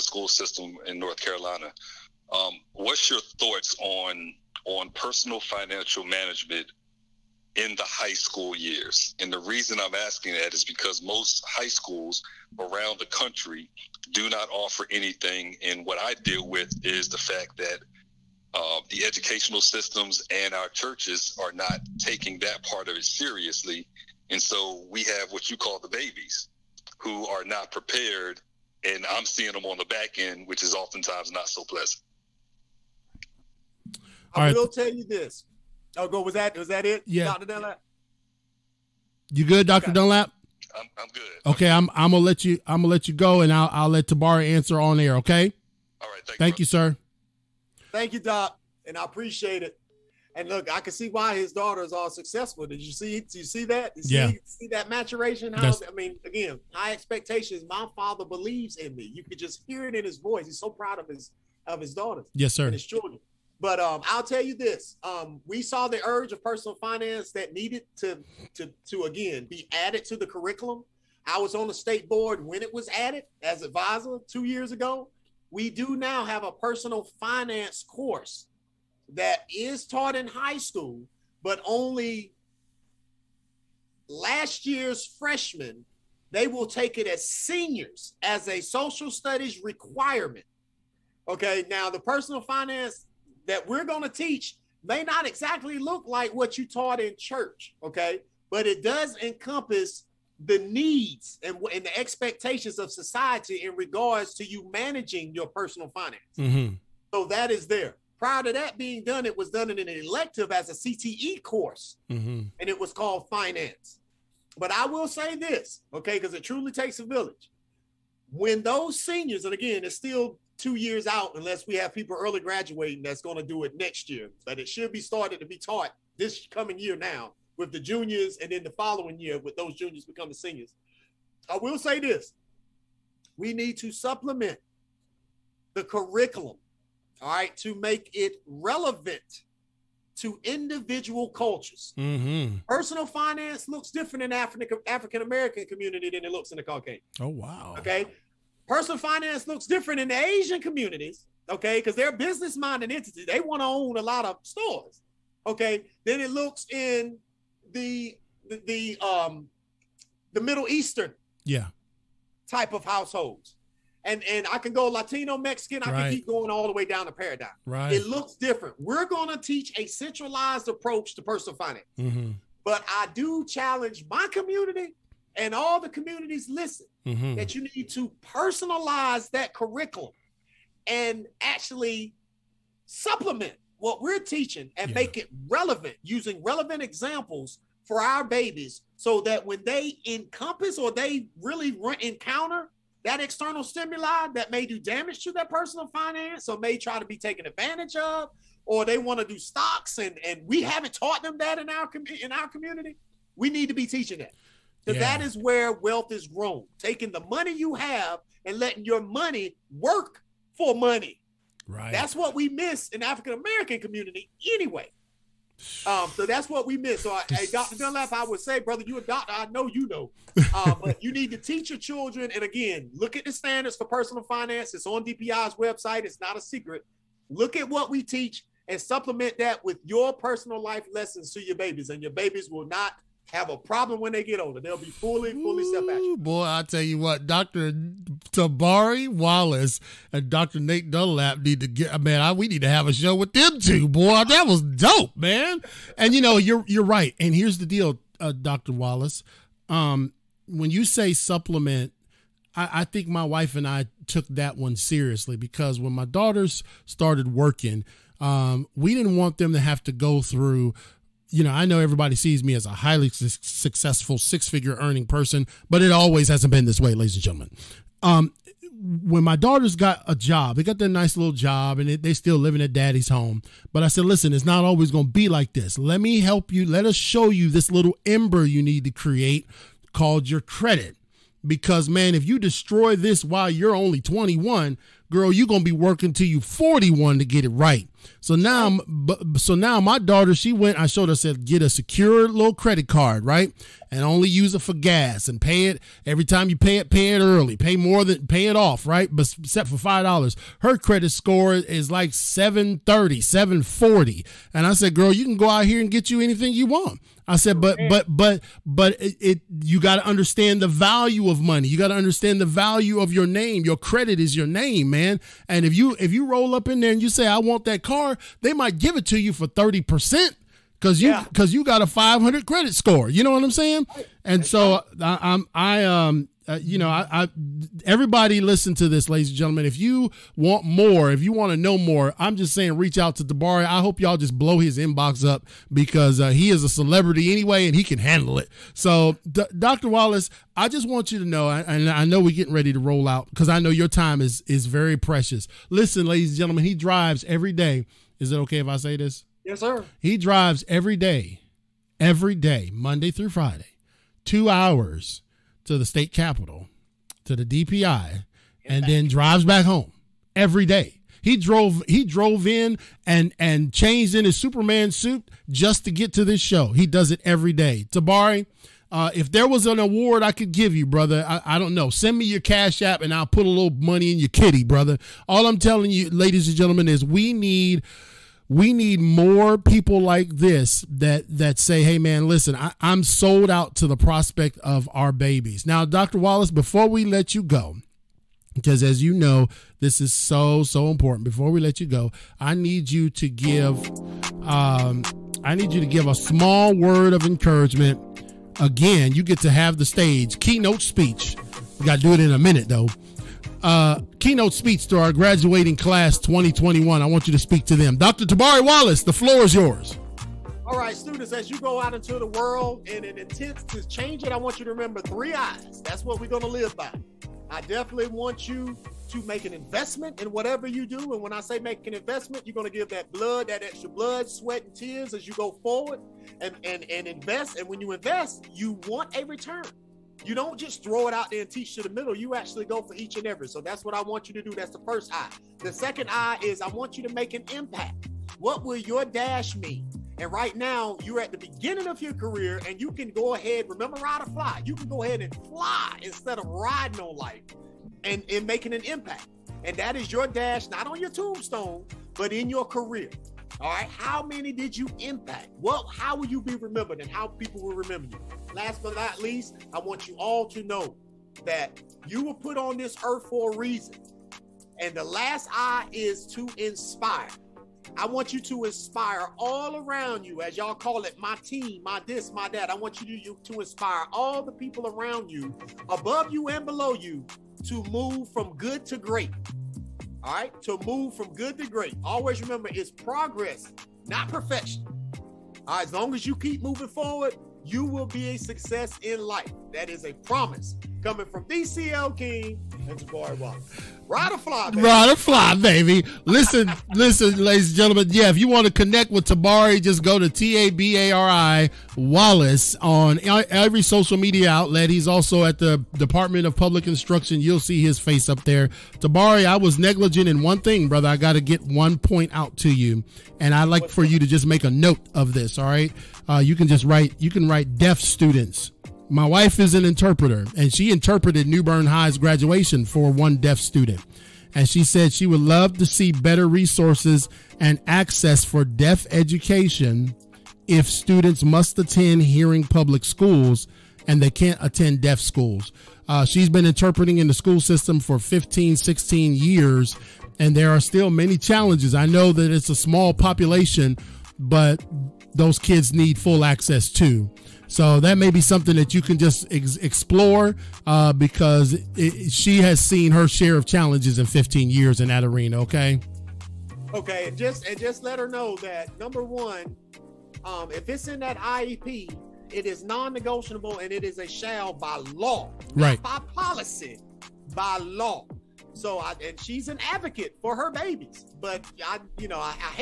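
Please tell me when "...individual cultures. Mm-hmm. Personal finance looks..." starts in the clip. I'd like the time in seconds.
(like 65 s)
140 s.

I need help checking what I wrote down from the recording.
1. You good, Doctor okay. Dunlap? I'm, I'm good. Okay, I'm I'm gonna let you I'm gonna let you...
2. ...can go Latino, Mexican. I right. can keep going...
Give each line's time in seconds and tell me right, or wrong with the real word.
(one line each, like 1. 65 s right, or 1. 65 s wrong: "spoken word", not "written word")
1. 39 s right
2. 164 s right.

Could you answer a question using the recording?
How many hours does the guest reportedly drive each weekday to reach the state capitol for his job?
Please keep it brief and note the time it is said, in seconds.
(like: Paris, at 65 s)
2 hours, at 354 s.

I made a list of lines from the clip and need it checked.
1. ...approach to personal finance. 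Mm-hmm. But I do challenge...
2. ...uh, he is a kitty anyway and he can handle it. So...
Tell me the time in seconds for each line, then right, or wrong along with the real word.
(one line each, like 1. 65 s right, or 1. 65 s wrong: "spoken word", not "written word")
1. 170 s right
2. 336 s wrong: "celebrity", not "kitty".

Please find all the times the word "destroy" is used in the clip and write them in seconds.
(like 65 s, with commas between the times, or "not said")
282 s.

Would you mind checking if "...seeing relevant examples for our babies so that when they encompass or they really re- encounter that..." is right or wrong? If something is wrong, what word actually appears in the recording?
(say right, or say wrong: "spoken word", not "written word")
wrong: "using", not "seeing".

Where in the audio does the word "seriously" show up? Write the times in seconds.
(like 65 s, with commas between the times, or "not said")
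23 s, 254 s.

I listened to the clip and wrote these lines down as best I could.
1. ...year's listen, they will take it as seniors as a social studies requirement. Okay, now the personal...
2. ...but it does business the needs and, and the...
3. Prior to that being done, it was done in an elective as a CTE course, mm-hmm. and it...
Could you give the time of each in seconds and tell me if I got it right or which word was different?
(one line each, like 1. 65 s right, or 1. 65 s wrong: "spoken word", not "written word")
1. 84 s wrong: "freshmen", not "listen"
2. 98 s wrong: "encompass", not "business"
3. 108 s right.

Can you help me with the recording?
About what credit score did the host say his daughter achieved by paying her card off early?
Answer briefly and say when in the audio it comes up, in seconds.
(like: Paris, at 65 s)
730, at 302 s.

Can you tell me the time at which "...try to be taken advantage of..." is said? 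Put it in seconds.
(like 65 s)
196 s.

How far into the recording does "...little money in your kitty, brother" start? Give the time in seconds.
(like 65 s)
373 s.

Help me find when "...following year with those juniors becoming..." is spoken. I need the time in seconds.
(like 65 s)
128 s.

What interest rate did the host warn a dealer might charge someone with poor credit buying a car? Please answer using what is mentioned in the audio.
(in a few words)
30 percent.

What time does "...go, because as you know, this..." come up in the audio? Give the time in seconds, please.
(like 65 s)
387 s.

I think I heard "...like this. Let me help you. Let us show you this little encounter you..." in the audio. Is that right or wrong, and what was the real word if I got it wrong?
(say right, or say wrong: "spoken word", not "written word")
wrong: "ember", not "encounter".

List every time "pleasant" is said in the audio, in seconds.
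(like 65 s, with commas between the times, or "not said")
31 s.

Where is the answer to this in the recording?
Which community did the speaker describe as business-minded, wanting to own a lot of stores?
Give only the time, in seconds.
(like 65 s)
150 s.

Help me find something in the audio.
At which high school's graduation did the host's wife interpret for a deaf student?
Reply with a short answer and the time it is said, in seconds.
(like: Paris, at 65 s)
New Bern High, at 521 s.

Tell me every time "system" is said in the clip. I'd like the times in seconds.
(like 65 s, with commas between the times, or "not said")
0 s, 19 s, 537 s.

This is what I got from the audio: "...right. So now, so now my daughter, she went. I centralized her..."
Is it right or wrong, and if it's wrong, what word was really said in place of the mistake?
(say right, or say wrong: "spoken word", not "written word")
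wrong: "showed", not "centralized".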